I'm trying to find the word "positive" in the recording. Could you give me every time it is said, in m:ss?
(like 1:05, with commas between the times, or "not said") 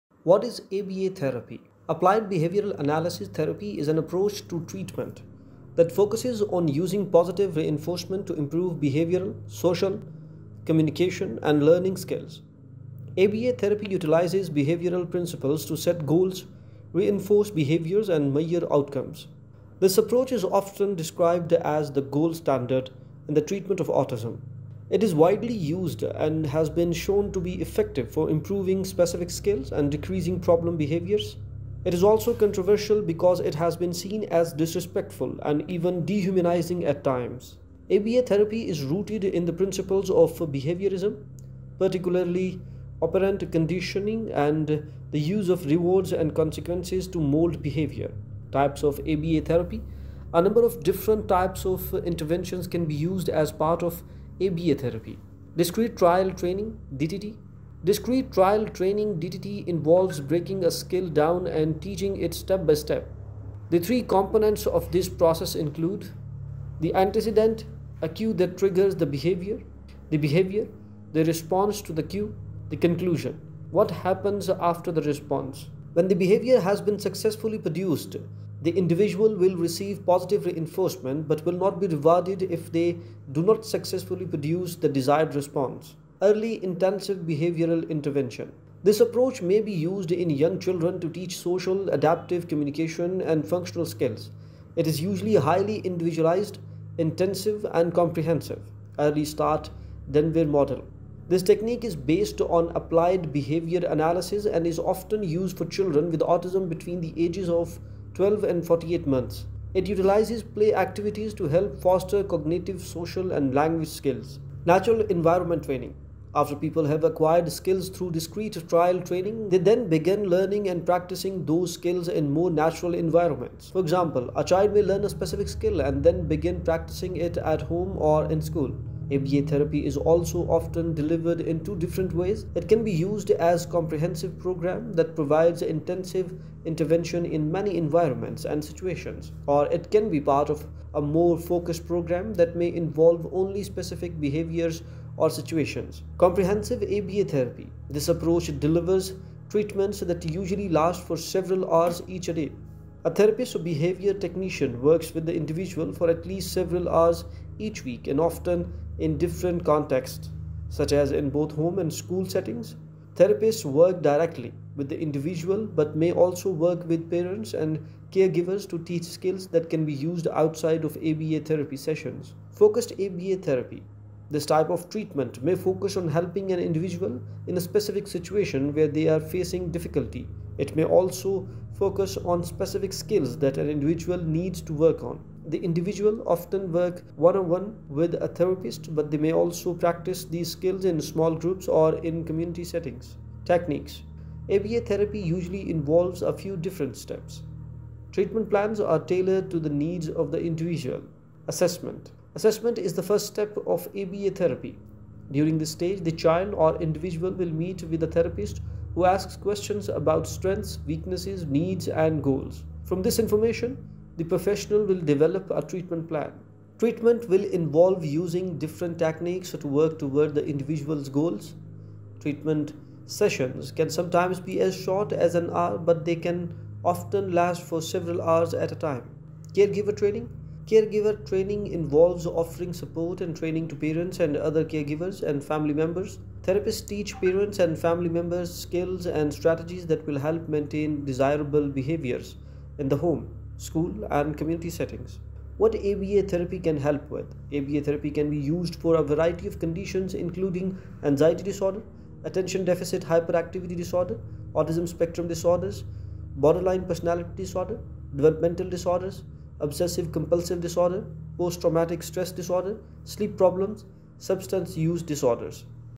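0:07, 1:20.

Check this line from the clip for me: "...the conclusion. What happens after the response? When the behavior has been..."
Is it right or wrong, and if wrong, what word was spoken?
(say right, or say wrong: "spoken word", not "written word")
right.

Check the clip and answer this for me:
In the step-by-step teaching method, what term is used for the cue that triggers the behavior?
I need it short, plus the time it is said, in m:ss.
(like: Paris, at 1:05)
Antecedent, at 1:06.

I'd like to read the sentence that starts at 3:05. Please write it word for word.
The individual often work one-on-one with a therapist, but they may also practice these skills in small groups or in community settings.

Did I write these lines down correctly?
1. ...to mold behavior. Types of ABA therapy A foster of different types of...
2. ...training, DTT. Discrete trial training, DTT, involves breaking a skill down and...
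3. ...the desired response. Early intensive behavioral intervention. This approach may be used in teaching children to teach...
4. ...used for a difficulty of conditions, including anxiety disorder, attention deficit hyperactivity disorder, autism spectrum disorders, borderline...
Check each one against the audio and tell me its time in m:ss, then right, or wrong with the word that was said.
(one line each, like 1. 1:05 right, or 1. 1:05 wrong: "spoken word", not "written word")
1. 0:47 wrong: "number", not "foster"
2. 0:56 right
3. 1:24 wrong: "young", not "teaching"
4. 4:08 wrong: "variety", not "difficulty".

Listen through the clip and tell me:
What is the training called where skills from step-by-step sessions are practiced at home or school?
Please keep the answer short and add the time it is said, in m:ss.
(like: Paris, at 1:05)
Natural environment training, at 1:54.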